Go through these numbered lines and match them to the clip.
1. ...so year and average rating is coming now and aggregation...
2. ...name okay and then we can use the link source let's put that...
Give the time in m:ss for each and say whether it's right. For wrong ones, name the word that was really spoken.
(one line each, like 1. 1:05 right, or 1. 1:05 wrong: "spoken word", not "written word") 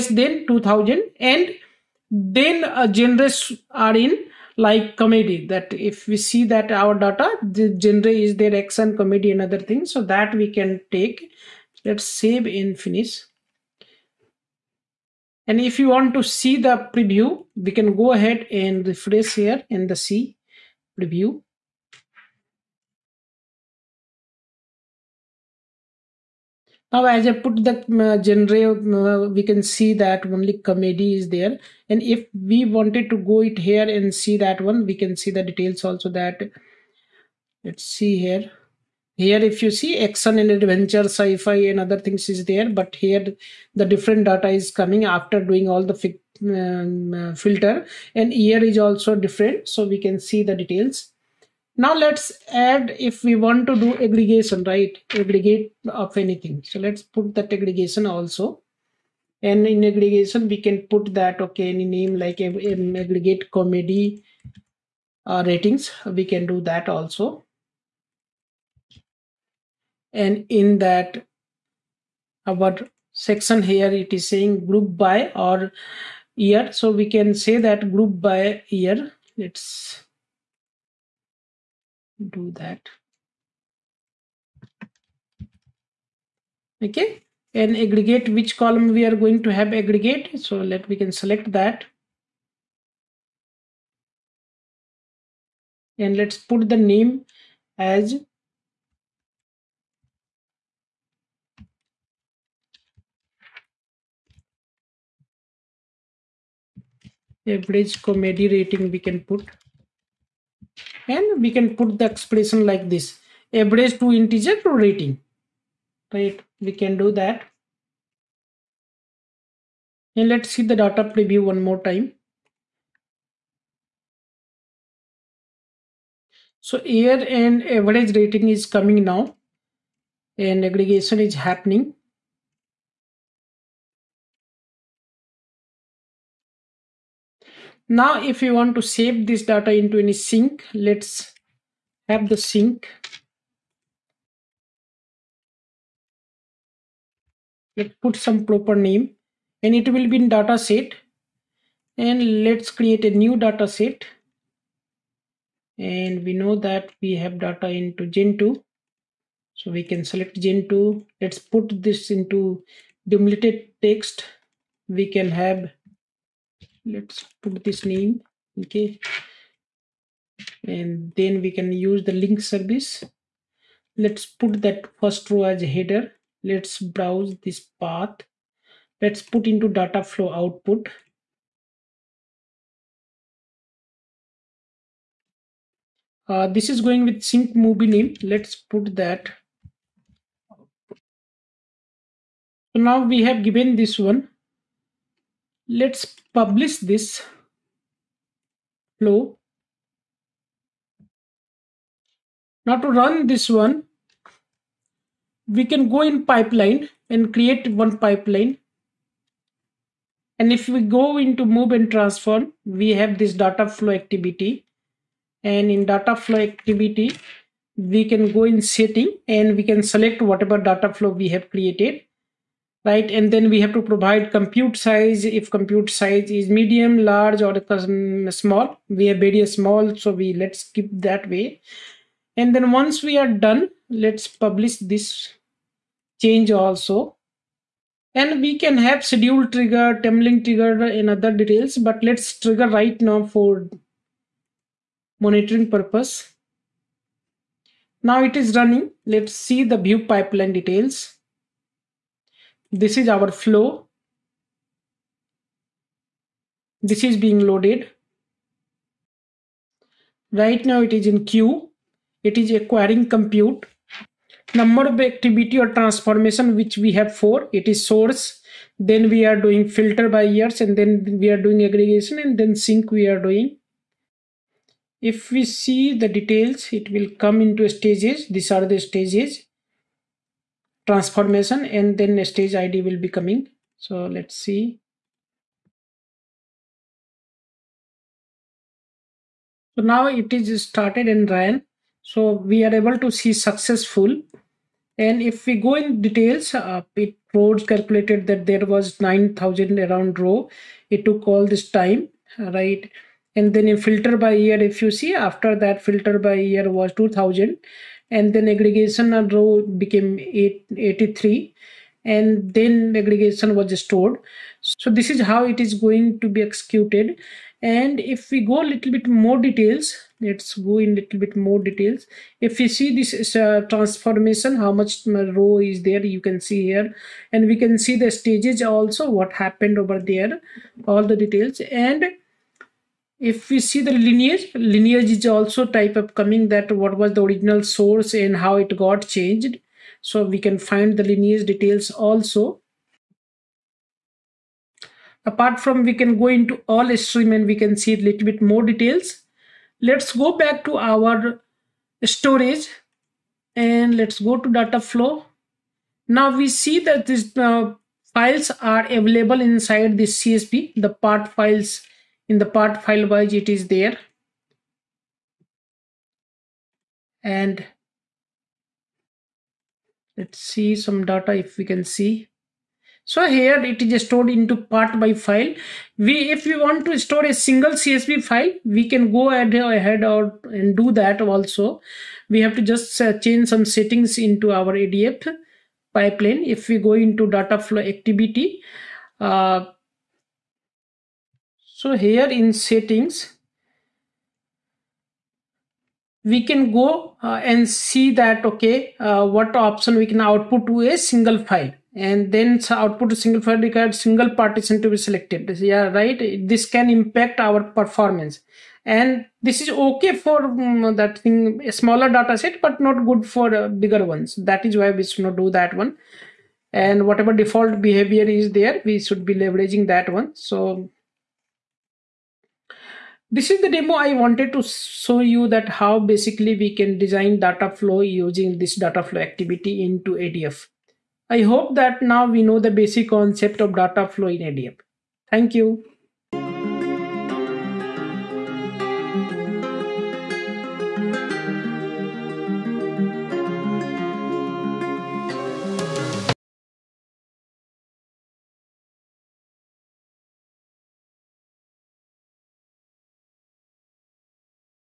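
1. 2:06 right
2. 2:47 wrong: "service", not "source".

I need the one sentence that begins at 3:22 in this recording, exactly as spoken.
Now to run this one, we can go in pipeline and create one pipeline.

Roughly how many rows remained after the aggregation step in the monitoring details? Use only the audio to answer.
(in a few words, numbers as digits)
83.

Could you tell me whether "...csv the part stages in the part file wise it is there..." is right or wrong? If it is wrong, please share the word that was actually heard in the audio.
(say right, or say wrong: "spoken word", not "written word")
wrong: "files", not "stages".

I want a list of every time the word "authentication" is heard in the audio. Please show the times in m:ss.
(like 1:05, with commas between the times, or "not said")
not said.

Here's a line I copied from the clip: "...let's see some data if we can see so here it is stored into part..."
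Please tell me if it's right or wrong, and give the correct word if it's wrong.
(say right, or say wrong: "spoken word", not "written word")
right.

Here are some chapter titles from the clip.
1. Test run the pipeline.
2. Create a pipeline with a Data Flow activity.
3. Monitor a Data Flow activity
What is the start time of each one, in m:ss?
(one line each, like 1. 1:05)
1. 3:53
2. 3:23
3. 4:08.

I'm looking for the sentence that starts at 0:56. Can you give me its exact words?
So let's put that aggregation also.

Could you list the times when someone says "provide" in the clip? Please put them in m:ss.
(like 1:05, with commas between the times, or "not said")
3:43.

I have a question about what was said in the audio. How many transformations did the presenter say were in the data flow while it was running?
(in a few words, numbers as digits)
4.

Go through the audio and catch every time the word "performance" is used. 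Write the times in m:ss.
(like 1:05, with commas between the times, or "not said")
6:47.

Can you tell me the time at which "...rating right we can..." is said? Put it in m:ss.
1:54.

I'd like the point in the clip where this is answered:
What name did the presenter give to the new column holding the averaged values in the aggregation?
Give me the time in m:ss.
1:47.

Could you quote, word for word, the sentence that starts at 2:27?
Let's put some proper name and it will be in data set.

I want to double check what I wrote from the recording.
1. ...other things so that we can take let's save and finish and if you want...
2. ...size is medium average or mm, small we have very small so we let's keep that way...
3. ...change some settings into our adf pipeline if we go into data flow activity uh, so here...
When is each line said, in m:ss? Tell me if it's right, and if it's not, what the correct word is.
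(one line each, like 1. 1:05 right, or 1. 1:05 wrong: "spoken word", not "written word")
1. 0:09 right
2. 3:45 wrong: "large", not "average"
3. 6:23 right.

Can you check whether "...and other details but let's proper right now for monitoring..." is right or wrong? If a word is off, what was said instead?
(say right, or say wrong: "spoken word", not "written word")
wrong: "trigger", not "proper".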